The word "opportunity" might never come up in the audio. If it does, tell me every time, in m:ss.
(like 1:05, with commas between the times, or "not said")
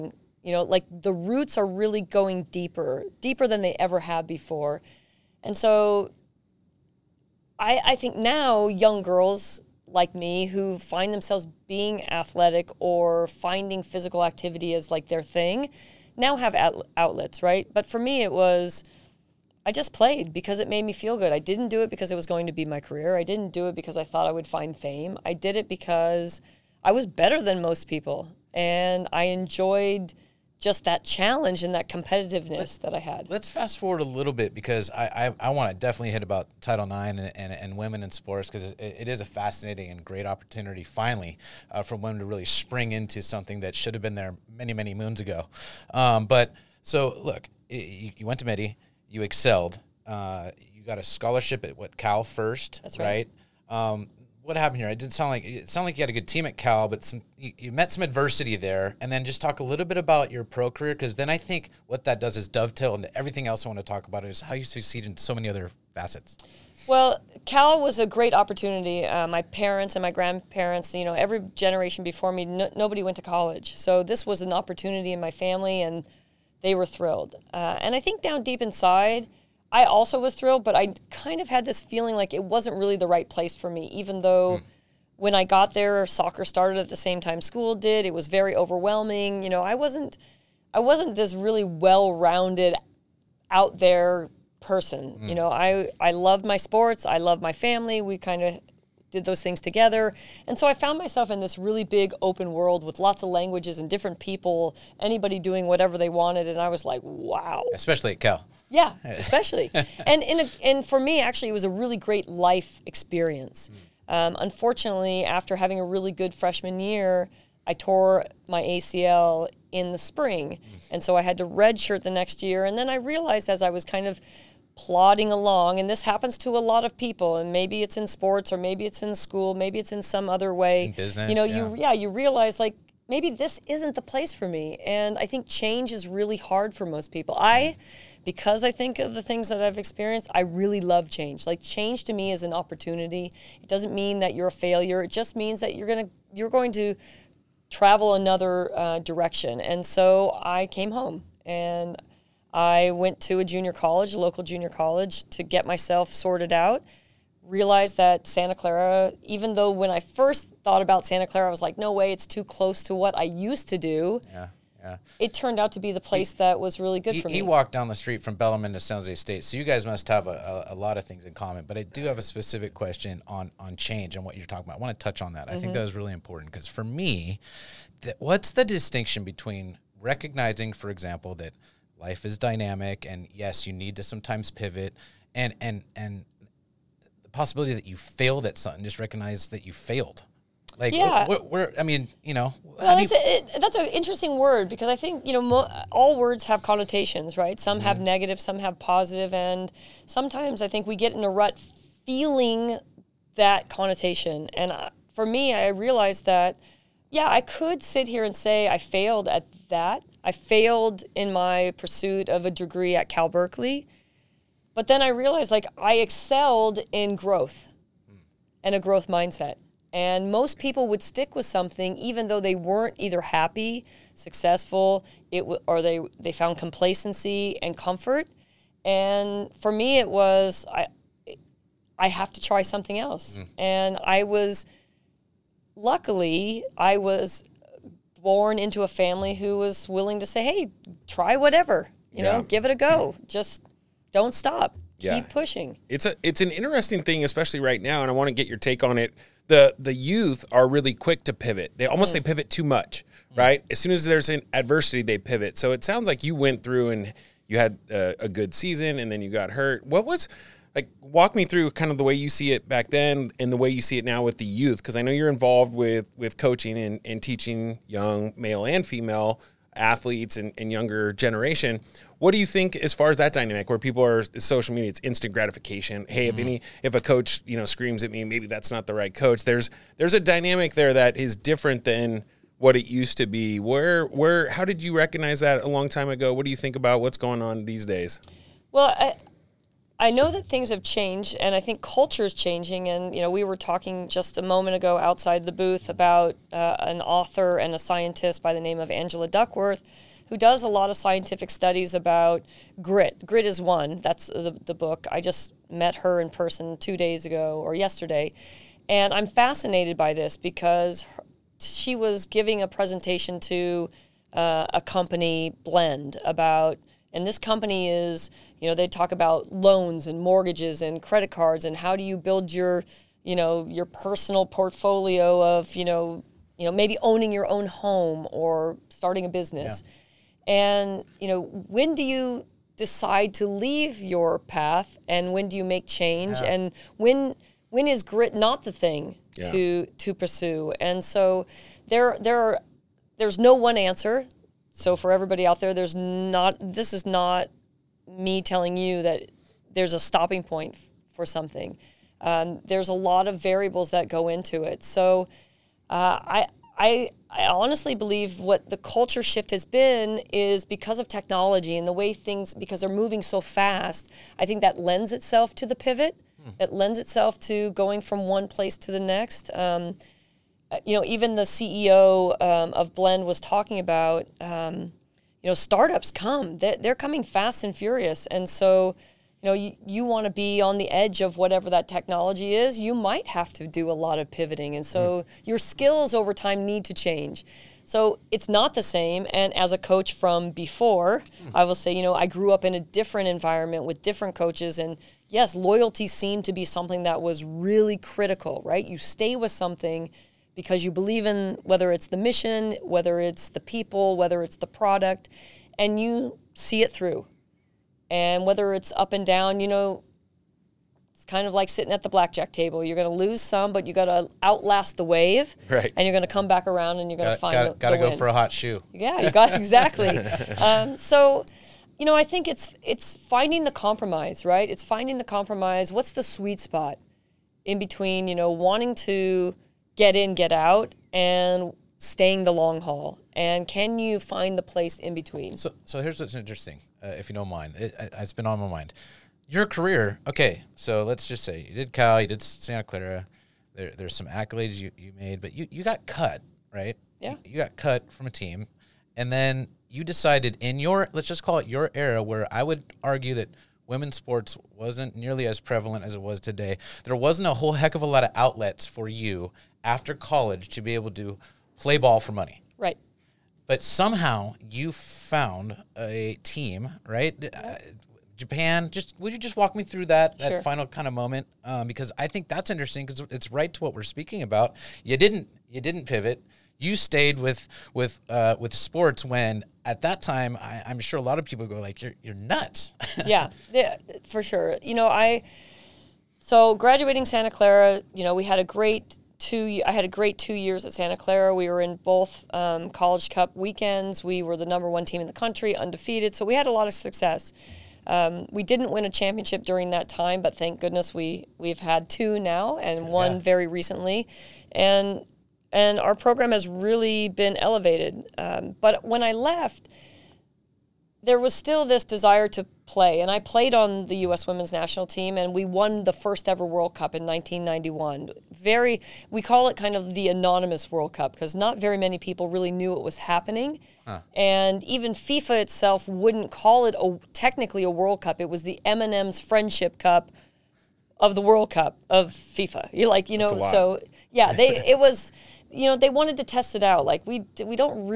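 0:40, 1:08, 1:14, 2:22.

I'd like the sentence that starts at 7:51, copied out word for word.
Um, because I think that's interesting because it's right to what we're speaking about.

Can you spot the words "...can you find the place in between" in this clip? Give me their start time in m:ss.
7:13.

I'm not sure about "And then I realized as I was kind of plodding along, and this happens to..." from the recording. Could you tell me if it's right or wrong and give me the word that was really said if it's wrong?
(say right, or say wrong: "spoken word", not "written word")
right.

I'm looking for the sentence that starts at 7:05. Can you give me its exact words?
What's the sweet spot in between?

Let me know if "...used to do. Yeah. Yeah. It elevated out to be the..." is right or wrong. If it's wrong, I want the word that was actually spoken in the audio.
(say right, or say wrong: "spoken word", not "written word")
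wrong: "turned", not "elevated".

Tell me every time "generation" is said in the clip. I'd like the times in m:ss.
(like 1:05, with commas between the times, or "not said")
1:11, 4:31.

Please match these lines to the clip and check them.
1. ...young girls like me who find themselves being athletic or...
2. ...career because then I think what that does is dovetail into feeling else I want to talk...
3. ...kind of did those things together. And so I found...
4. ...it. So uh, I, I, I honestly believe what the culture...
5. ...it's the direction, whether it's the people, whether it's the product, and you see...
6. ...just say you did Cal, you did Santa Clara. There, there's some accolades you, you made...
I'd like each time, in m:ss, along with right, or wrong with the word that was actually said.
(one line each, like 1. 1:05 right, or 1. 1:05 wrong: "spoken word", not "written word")
1. 0:08 right
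2. 1:00 wrong: "everything", not "feeling"
3. 1:38 right
4. 5:54 right
5. 6:41 wrong: "mission", not "direction"
6. 7:21 right.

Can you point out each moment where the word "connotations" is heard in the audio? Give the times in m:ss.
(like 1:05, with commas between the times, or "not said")
3:16, 3:23.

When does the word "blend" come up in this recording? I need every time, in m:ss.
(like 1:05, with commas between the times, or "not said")
5:15, 6:12.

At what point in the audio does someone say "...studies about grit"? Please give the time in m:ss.
5:01.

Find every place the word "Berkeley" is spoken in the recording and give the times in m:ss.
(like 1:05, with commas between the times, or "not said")
3:33.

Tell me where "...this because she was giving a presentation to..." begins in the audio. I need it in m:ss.
5:10.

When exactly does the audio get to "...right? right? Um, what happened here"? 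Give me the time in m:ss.
0:52.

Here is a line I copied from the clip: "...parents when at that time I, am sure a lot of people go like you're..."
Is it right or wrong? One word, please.
wrong.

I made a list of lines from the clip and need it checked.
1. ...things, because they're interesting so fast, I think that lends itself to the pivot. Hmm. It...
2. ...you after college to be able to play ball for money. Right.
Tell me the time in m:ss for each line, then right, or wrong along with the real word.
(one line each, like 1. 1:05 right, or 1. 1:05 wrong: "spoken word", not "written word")
1. 6:02 wrong: "moving", not "interesting"
2. 7:39 right.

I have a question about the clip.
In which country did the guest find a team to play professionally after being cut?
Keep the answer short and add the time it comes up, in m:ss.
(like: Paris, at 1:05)
Japan, at 7:48.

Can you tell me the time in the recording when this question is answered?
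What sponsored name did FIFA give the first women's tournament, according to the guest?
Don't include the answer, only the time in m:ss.
8:48.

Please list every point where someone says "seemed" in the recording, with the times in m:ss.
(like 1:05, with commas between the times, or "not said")
6:36.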